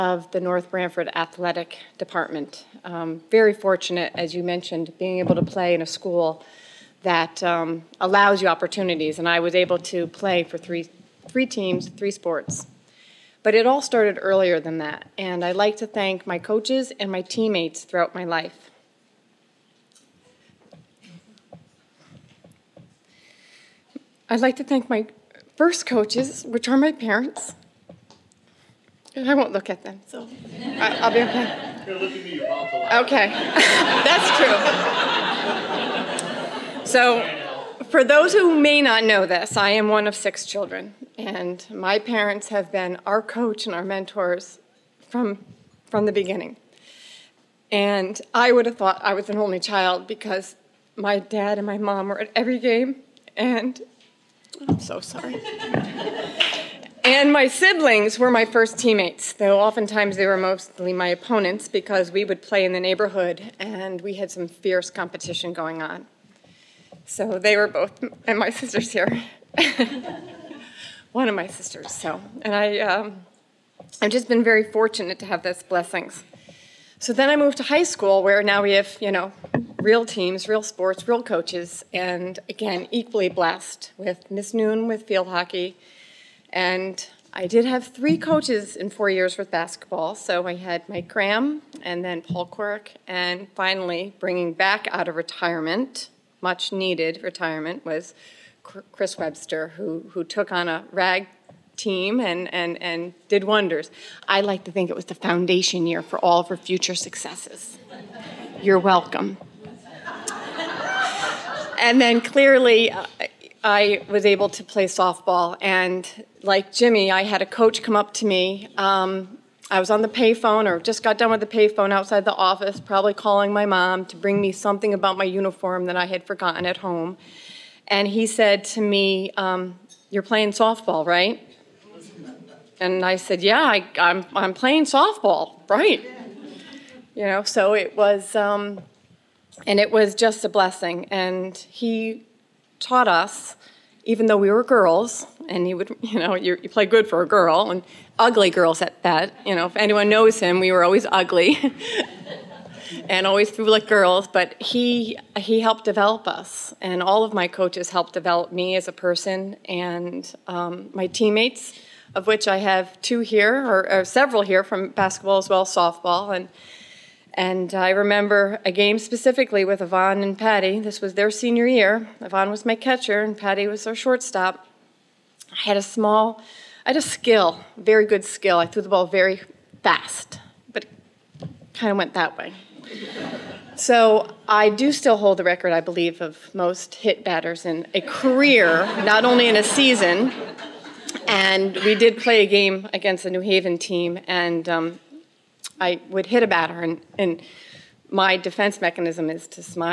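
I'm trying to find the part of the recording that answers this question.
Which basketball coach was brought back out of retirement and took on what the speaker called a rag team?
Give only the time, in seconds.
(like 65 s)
98 s.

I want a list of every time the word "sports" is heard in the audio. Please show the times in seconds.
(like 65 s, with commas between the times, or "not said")
12 s, 80 s.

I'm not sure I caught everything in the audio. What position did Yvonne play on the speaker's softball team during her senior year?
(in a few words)
Catcher.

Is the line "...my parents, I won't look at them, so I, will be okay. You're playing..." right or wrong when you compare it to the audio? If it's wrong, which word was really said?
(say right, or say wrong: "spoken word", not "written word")
wrong: "looking", not "playing".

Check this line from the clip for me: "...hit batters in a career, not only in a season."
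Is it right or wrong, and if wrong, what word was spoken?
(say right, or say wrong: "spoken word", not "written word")
right.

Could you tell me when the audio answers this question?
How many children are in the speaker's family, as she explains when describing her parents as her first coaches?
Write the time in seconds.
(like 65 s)
40 s.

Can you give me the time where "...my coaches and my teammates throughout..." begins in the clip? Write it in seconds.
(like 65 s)
16 s.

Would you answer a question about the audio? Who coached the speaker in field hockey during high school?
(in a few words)
Miss Noon.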